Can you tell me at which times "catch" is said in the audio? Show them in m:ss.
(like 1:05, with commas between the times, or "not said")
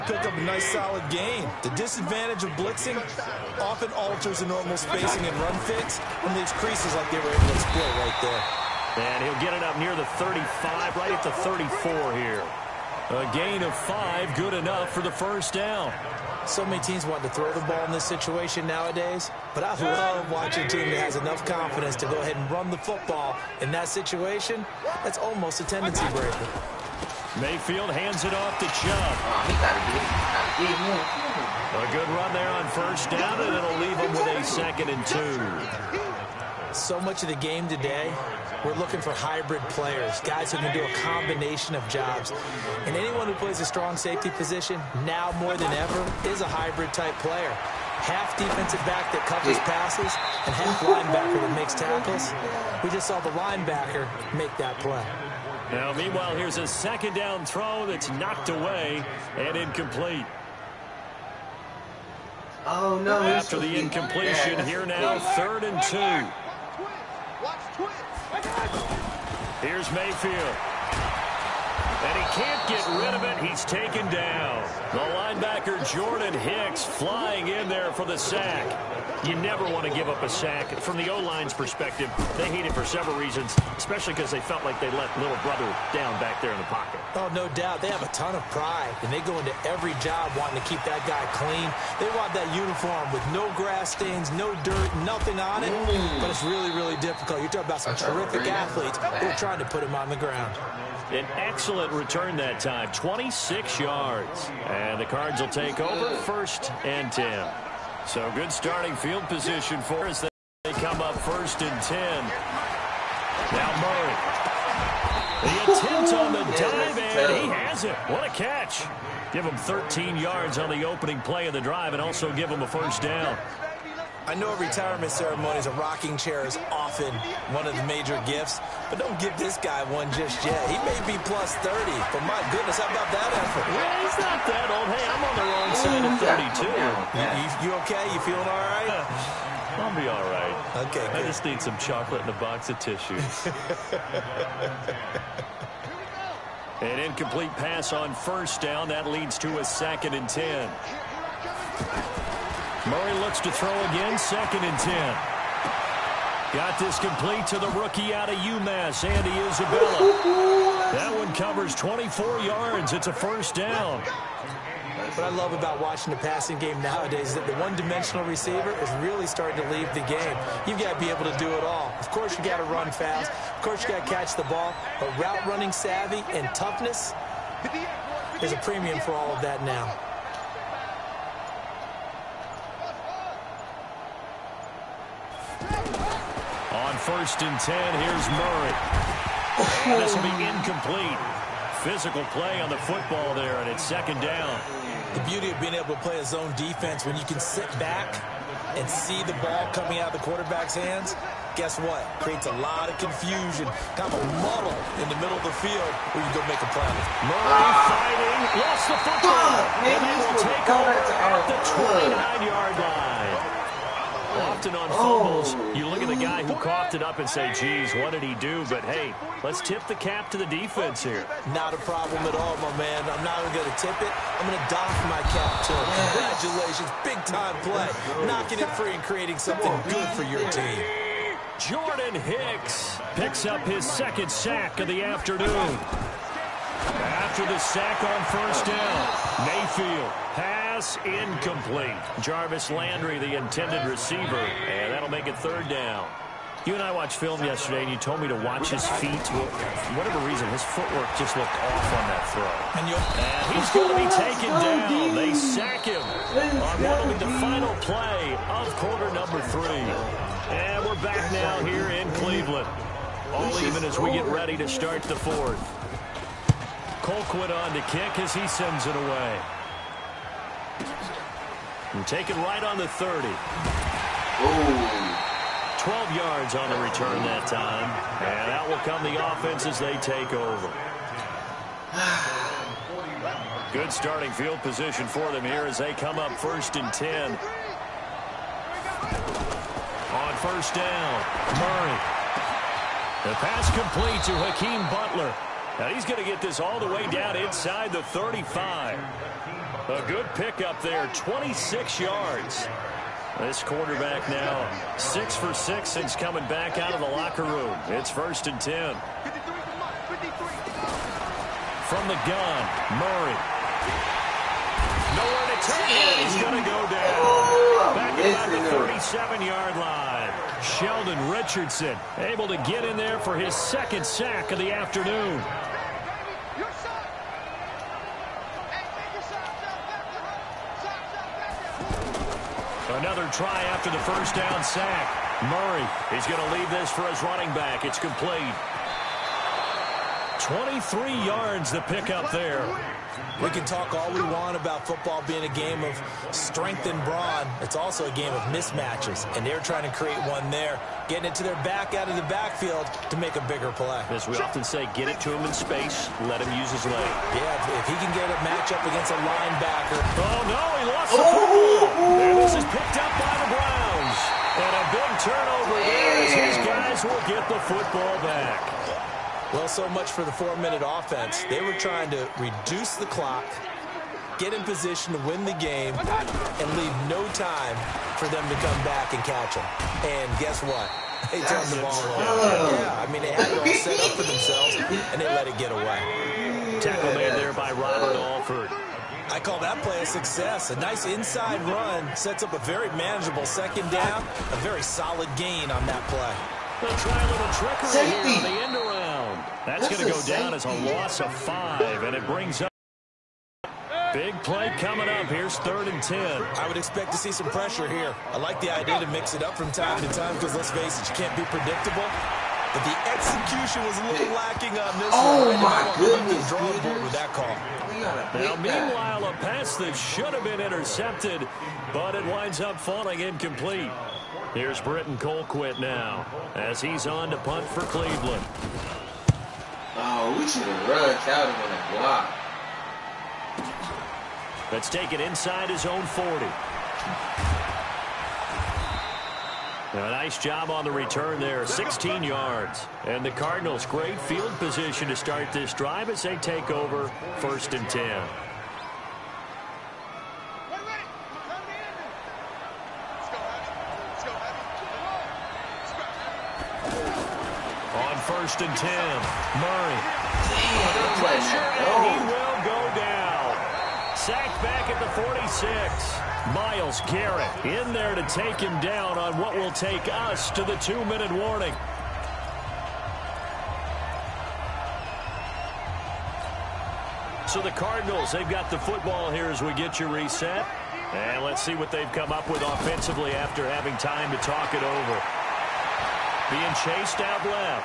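1:58, 2:54, 6:19.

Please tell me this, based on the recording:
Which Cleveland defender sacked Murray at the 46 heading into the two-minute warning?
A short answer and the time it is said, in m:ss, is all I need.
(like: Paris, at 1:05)
Myles Garrett, at 7:46.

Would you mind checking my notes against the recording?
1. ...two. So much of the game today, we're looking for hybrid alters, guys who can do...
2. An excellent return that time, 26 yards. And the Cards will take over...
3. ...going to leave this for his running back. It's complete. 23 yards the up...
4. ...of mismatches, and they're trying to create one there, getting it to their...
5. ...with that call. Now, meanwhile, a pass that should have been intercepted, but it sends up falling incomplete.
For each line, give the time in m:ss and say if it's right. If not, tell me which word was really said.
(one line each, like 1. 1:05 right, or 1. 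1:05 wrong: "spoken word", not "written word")
1. 0:35 wrong: "players", not "alters"
2. 1:41 right
3. 5:36 right
4. 5:48 right
5. 6:57 wrong: "winds", not "sends".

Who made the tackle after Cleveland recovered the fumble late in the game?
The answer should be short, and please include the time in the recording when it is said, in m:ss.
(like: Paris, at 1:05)
Robert Alford, at 6:27.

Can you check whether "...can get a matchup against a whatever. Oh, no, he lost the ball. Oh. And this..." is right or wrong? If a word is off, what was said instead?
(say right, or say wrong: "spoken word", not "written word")
wrong: "linebacker", not "whatever".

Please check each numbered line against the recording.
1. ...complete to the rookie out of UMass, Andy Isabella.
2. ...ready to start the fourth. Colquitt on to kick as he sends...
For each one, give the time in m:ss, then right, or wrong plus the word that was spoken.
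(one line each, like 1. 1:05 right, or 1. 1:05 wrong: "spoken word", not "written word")
1. 2:36 right
2. 4:24 right.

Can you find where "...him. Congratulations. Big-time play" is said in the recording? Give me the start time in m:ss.
3:45.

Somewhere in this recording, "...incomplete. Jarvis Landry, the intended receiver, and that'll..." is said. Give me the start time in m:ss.
4:01.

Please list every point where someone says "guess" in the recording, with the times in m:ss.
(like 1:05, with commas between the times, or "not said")
3:21, 6:20.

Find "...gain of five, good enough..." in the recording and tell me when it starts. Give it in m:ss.
0:13.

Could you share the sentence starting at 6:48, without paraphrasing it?
I like the idea to mix it up from time to time because let's face it, you can't be predictable.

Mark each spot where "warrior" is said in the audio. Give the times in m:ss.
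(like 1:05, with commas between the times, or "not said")
not said.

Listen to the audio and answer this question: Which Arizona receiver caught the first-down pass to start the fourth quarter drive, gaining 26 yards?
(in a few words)
Hakeem Butler.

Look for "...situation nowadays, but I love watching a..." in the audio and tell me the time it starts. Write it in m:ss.
0:18.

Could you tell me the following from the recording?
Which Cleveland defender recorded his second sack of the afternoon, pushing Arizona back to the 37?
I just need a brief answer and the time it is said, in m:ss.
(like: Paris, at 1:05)
Sheldon Richardson, at 5:20.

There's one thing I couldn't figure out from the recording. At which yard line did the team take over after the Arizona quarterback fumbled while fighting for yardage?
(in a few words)
29.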